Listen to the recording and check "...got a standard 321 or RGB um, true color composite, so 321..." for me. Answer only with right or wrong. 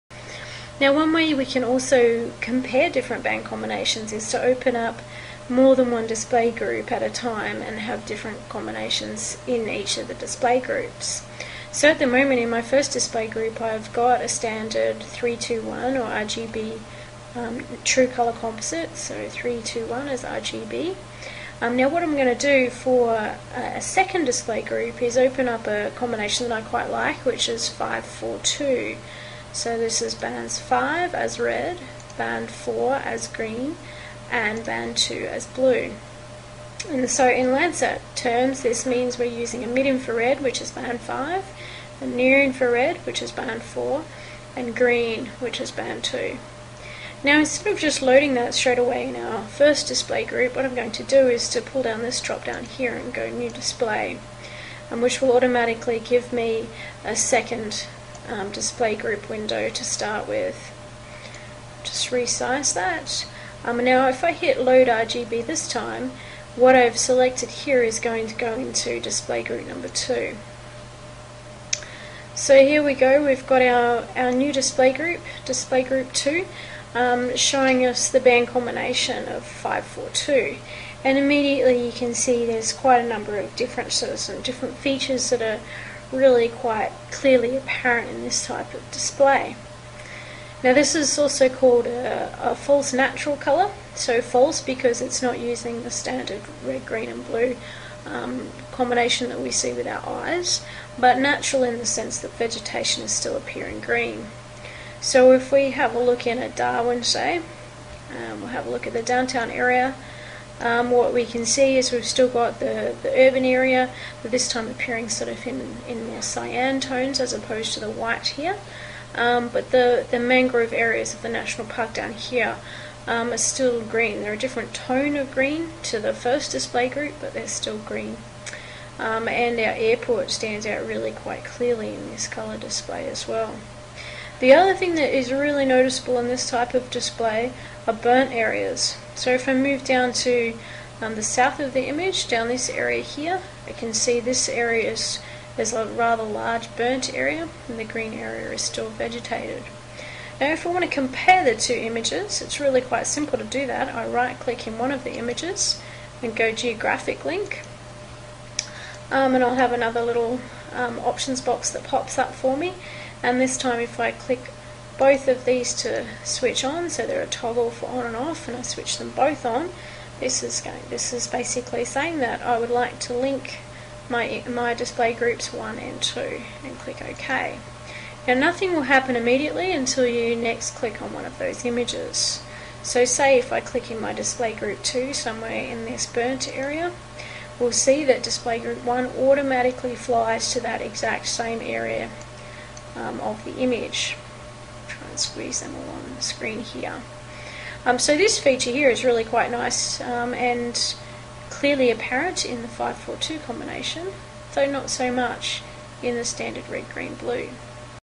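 right.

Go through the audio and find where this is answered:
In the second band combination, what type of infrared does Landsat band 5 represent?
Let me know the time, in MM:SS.
00:39.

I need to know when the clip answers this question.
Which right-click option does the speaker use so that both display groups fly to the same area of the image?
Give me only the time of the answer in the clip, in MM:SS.
02:36.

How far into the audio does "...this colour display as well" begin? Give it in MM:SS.
02:12.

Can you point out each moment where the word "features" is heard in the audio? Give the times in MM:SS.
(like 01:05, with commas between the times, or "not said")
01:24, 03:18.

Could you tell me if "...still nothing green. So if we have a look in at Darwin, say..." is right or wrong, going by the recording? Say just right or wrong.
wrong.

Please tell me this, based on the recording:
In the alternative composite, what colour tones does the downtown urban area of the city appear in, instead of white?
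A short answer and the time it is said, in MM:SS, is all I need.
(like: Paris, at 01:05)
cyan, at 01:56.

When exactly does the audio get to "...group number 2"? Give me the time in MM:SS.
01:09.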